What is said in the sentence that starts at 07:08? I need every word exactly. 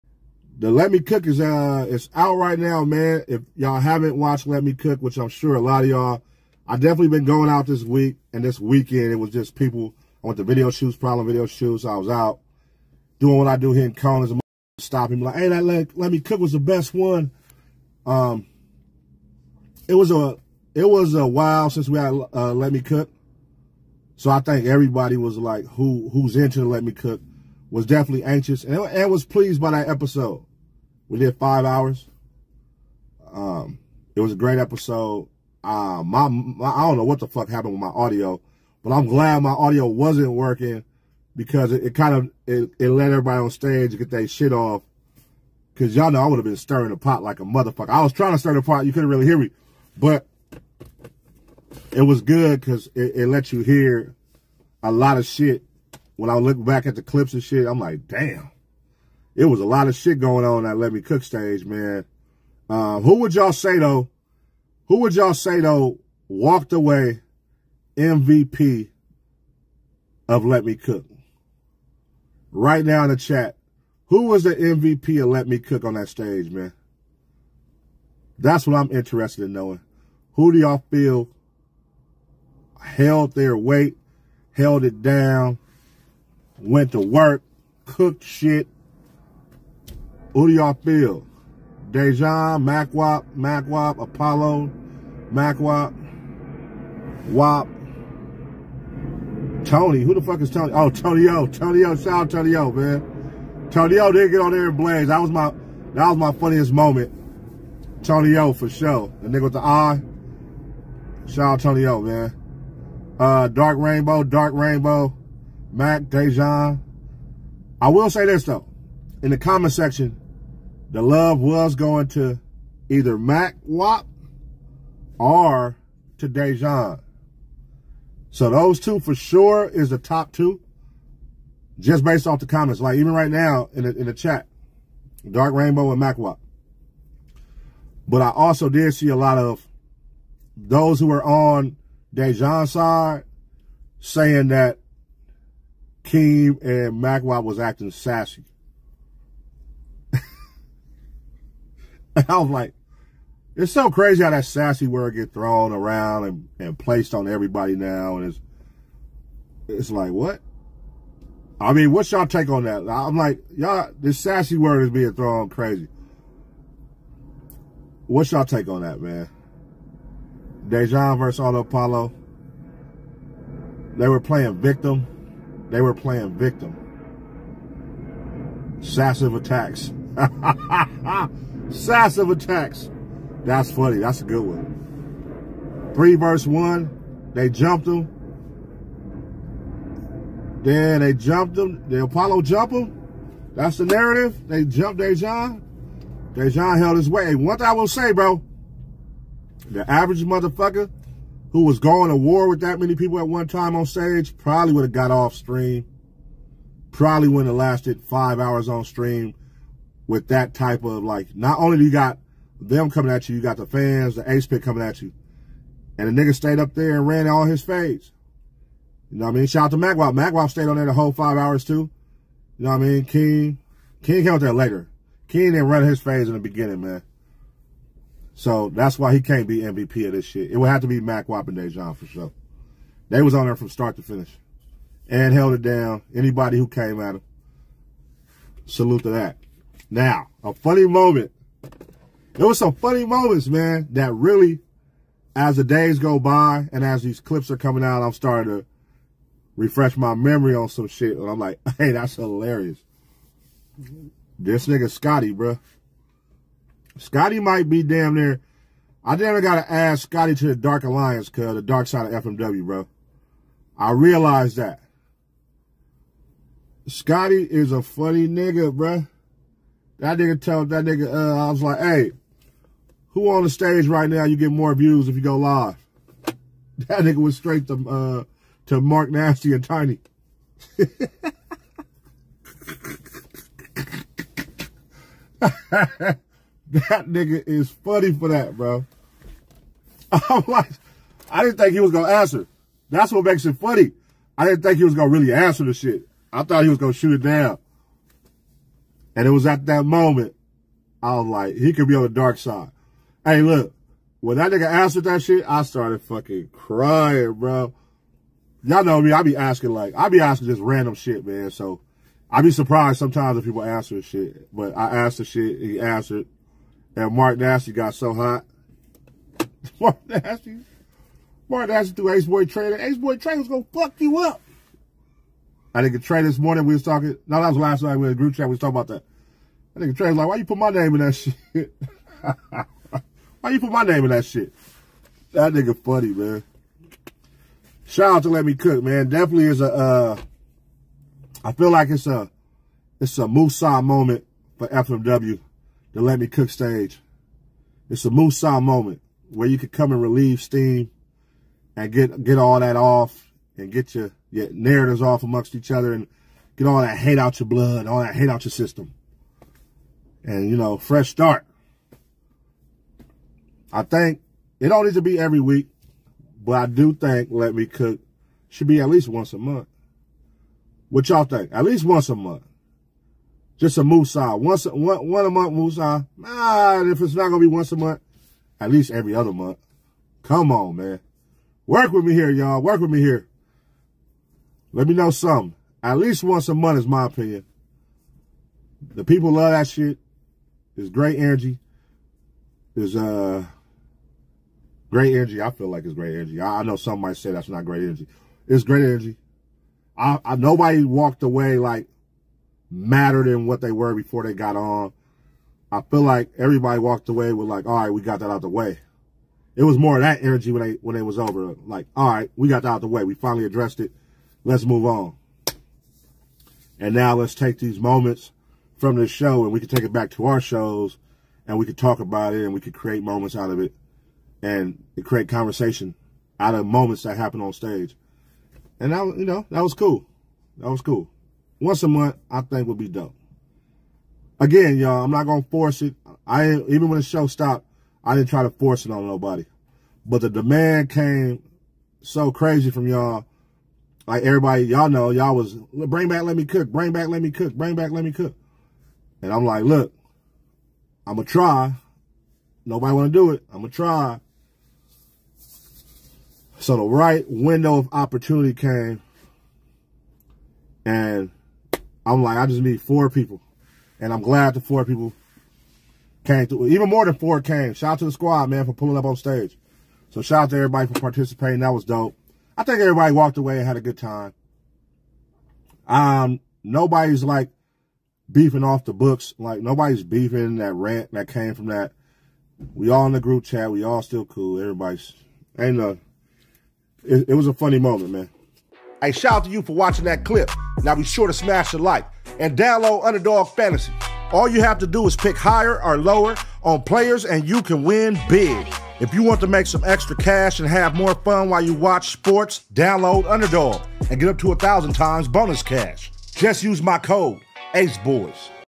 And that, you know, that was cool.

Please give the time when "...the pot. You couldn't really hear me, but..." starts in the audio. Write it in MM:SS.
00:48.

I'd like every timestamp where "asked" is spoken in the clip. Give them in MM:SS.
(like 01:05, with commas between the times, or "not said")
05:14.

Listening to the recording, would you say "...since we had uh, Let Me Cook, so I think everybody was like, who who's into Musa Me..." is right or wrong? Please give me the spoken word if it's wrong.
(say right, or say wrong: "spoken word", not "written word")
wrong: "Let", not "Musa".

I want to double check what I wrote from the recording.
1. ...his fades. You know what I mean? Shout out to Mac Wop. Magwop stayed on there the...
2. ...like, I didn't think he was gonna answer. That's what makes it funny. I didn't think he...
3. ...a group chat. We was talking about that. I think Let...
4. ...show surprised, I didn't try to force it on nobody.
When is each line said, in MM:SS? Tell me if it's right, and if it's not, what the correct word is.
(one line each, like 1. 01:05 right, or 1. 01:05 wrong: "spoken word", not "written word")
1. 03:37 right
2. 04:50 right
3. 05:28 wrong: "Trey", not "Let"
4. 07:17 wrong: "stopped", not "surprised".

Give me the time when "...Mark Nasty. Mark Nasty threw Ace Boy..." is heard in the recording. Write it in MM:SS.
05:19.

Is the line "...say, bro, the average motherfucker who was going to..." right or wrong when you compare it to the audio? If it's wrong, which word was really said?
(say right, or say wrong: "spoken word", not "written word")
right.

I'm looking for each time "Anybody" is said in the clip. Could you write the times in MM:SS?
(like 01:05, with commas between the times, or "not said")
03:56.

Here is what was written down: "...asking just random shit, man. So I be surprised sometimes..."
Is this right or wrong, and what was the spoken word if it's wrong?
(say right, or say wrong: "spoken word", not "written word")
right.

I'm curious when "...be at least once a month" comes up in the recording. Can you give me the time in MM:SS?
06:08.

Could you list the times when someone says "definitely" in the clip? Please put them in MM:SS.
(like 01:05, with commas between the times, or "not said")
00:06, 00:27, 05:39.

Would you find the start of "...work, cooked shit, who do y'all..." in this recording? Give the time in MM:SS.
01:26.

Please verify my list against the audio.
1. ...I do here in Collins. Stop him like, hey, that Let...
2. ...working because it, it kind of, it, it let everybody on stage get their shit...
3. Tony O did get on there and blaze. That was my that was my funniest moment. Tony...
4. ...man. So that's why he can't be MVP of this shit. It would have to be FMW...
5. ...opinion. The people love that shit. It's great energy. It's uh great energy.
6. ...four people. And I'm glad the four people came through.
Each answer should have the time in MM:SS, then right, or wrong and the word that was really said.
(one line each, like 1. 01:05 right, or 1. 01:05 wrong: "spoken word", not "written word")
1. 00:13 right
2. 00:40 right
3. 01:43 right
4. 03:46 wrong: "Mac", not "FMW"
5. 06:27 right
6. 07:42 right.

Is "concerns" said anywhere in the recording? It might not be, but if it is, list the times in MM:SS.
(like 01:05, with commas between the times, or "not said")
not said.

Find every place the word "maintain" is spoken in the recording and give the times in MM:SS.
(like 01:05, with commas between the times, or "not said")
not said.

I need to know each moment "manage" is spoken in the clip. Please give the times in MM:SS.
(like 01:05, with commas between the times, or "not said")
not said.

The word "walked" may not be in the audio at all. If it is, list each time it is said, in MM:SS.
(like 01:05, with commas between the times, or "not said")
01:06, 06:40, 06:46, 07:53.